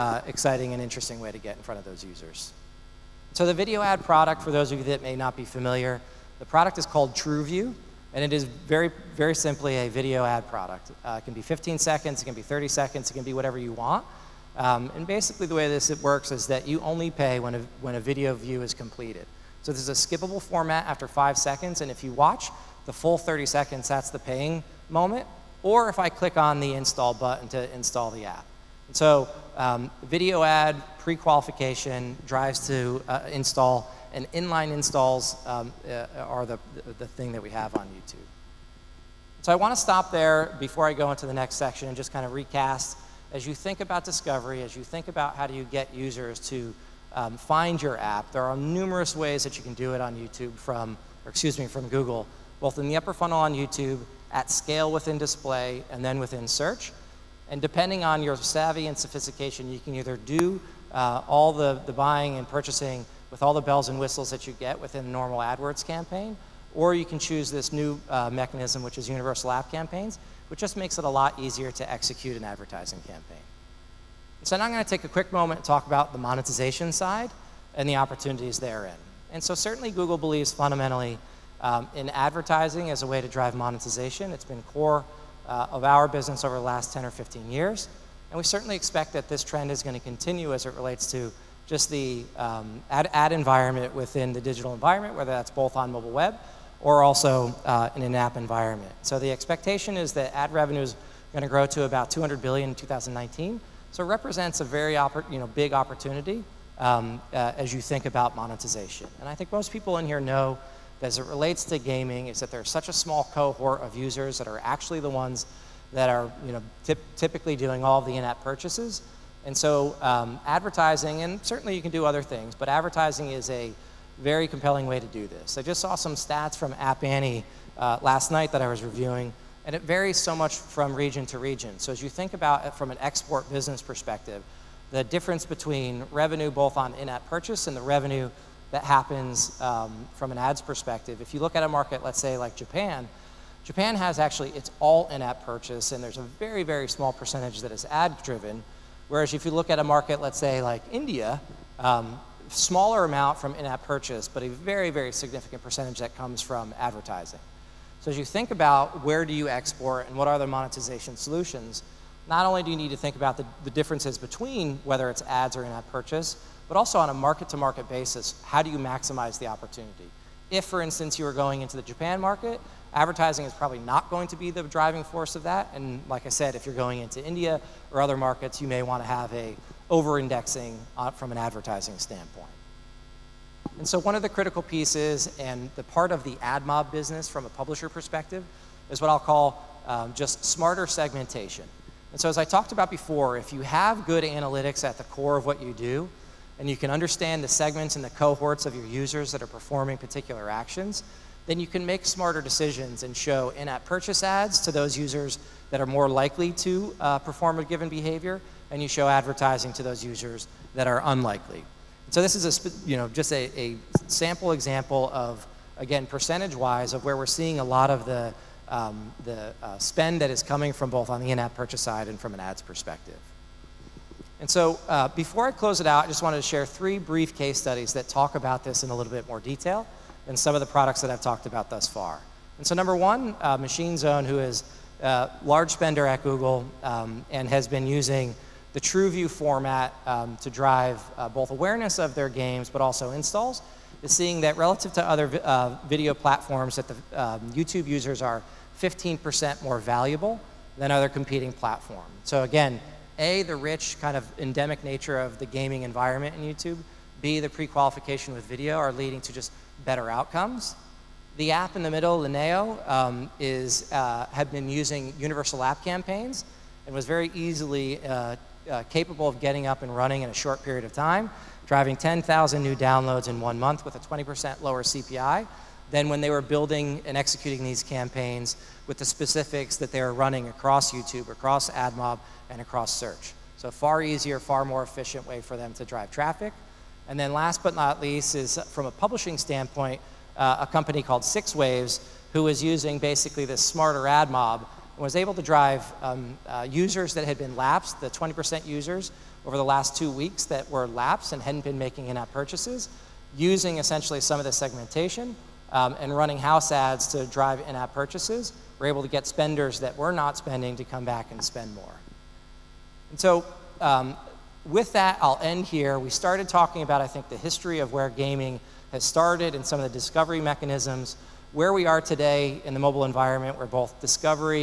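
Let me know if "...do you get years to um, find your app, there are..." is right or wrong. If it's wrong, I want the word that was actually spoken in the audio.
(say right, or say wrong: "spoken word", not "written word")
wrong: "users", not "years".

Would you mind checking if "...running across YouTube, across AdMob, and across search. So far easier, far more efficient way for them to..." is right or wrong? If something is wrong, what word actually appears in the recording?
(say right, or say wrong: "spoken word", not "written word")
right.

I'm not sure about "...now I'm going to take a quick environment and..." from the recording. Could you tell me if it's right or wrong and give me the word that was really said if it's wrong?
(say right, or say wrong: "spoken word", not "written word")
wrong: "moment", not "environment".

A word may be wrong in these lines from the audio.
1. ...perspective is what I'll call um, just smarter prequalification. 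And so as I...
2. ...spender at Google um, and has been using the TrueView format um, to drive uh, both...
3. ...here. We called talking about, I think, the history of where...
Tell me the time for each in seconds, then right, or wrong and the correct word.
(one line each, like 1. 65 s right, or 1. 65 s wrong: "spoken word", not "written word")
1. 187 s wrong: "segmentation", not "prequalification"
2. 235 s right
3. 315 s wrong: "started", not "called".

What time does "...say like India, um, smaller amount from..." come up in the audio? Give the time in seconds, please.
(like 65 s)
150 s.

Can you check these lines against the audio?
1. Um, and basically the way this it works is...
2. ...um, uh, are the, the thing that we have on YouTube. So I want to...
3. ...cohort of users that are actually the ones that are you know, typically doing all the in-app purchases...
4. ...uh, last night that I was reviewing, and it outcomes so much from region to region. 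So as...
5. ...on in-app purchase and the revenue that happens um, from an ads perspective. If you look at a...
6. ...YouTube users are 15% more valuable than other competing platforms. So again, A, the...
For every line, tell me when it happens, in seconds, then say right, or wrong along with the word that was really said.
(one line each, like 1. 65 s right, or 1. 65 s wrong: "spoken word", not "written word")
1. 14 s right
2. 35 s right
3. 113 s right
4. 127 s wrong: "varies", not "outcomes"
5. 136 s right
6. 247 s right.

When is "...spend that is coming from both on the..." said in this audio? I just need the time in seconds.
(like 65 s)
219 s.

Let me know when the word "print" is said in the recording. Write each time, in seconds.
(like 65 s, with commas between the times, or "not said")
not said.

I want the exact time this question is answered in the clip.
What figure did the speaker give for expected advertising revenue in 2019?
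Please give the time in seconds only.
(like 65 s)
102 s.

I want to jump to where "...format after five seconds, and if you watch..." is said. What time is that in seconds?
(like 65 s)
20 s.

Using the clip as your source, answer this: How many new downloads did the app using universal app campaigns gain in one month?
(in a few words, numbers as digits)
10,000.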